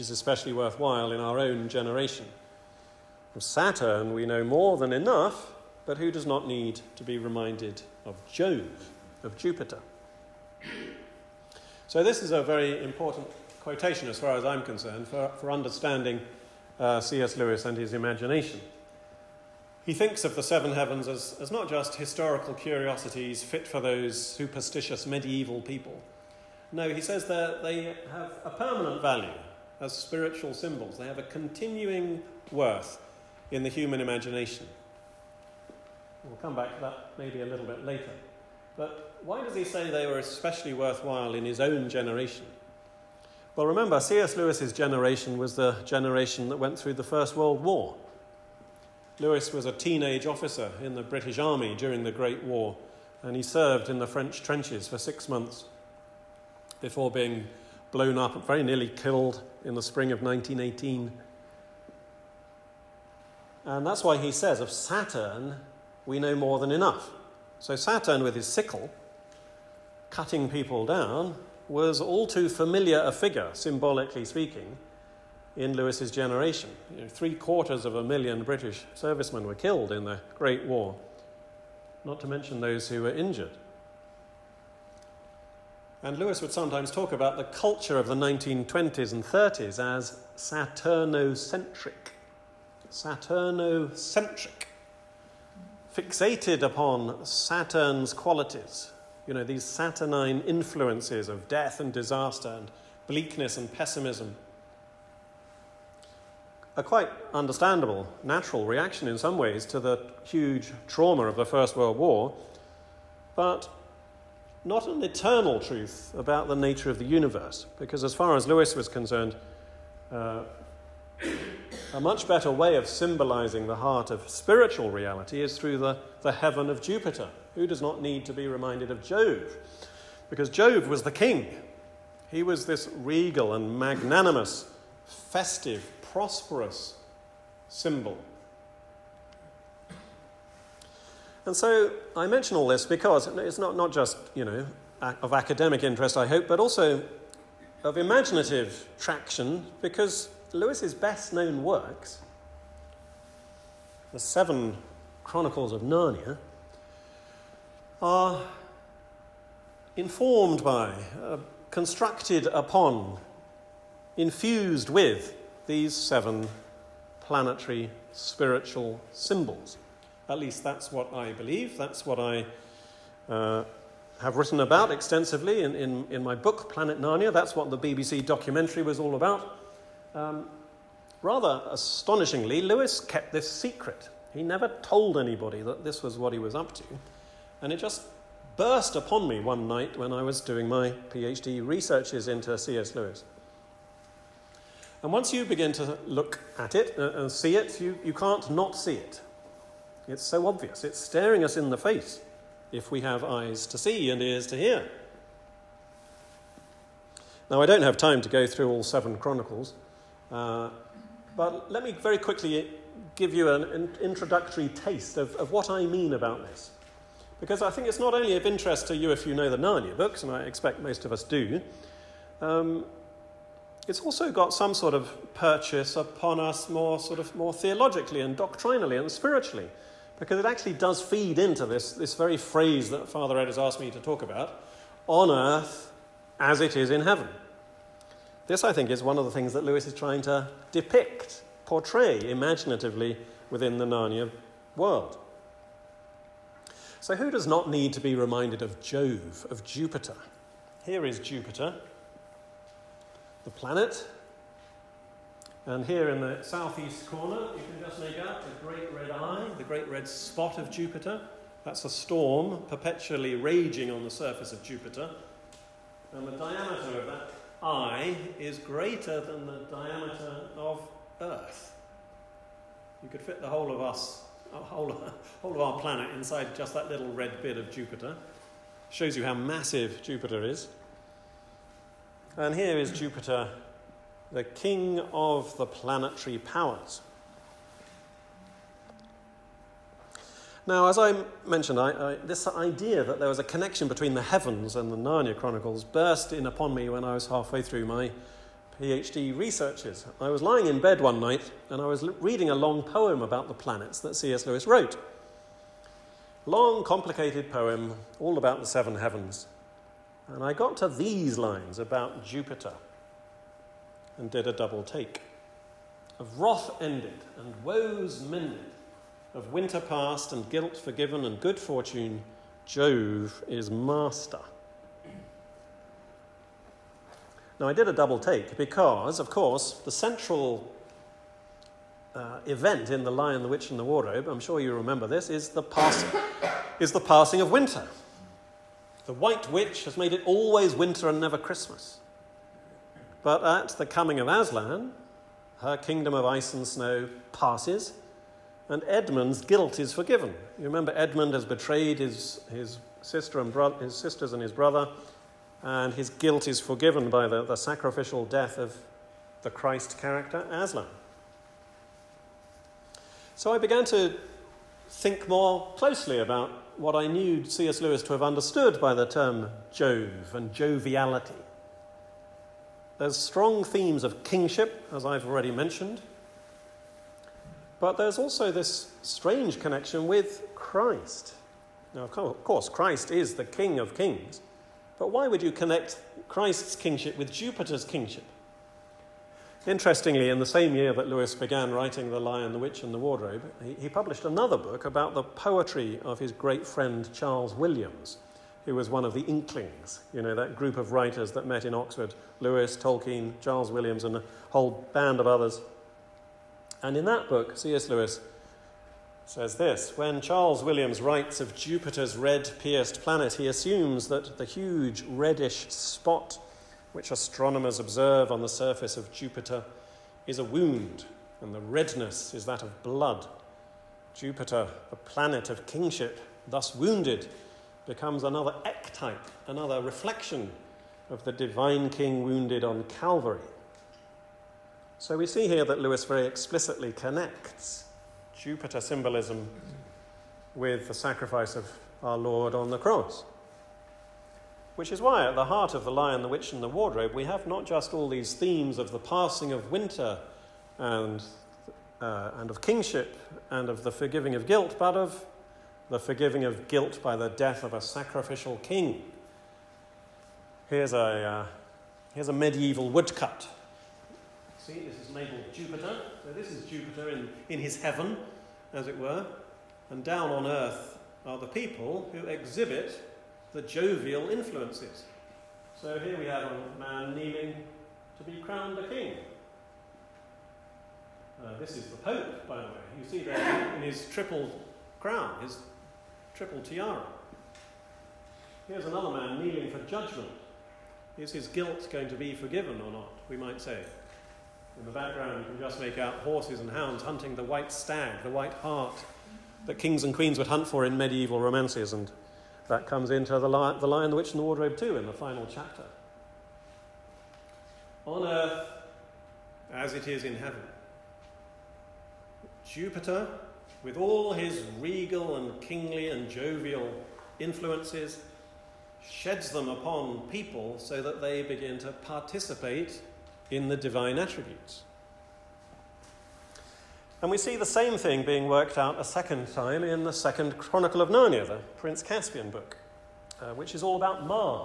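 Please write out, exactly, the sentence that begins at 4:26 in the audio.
And the diameter of that I is greater than the diameter of Earth.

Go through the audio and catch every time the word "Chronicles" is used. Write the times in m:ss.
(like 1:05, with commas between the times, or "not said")
2:35, 3:29, 4:55, 8:50.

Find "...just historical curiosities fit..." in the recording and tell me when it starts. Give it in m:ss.
0:21.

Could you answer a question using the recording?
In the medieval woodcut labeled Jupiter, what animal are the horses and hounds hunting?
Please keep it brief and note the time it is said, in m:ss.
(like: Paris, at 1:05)
white stag, at 8:17.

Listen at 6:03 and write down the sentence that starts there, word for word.
So I began to think more closely about what I knew C.S.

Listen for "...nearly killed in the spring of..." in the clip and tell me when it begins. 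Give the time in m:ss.
0:58.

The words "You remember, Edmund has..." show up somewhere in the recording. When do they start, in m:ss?
5:50.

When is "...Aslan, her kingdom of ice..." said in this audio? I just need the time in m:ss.
5:44.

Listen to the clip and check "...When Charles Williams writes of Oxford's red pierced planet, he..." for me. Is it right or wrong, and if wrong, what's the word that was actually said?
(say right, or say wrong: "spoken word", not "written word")
wrong: "Jupiter", not "Oxford".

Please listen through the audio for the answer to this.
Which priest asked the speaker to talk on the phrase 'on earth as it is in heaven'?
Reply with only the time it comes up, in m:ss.
3:53.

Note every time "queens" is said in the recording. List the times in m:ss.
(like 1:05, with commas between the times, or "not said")
8:20.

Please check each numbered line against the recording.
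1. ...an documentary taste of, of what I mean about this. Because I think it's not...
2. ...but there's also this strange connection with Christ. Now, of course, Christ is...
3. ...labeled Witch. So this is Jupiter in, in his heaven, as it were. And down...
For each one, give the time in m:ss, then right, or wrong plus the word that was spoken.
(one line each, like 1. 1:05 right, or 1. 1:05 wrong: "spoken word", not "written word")
1. 3:33 wrong: "introductory", not "documentary"
2. 6:17 right
3. 7:45 wrong: "Jupiter", not "Witch".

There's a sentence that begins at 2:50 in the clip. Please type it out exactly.
At least that's what I believe, that's what I uh, have written about extensively in, in, in my book, Planet Narnia.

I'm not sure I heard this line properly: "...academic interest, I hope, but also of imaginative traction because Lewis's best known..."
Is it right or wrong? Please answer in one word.
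right.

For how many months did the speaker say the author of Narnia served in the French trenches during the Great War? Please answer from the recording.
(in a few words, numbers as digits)
6.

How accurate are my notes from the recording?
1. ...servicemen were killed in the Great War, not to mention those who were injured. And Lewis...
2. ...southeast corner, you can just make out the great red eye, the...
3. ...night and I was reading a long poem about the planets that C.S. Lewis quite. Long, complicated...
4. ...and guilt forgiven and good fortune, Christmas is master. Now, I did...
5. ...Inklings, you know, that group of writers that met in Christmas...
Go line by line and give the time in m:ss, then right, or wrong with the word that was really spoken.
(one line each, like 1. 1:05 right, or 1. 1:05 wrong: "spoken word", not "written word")
1. 1:18 right
2. 4:16 right
3. 5:01 wrong: "wrote", not "quite"
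4. 5:20 wrong: "Jove", not "Christmas"
5. 6:39 wrong: "Oxford", not "Christmas".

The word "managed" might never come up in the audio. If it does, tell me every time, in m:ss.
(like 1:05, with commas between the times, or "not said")
not said.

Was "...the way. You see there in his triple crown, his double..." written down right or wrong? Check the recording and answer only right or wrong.
wrong.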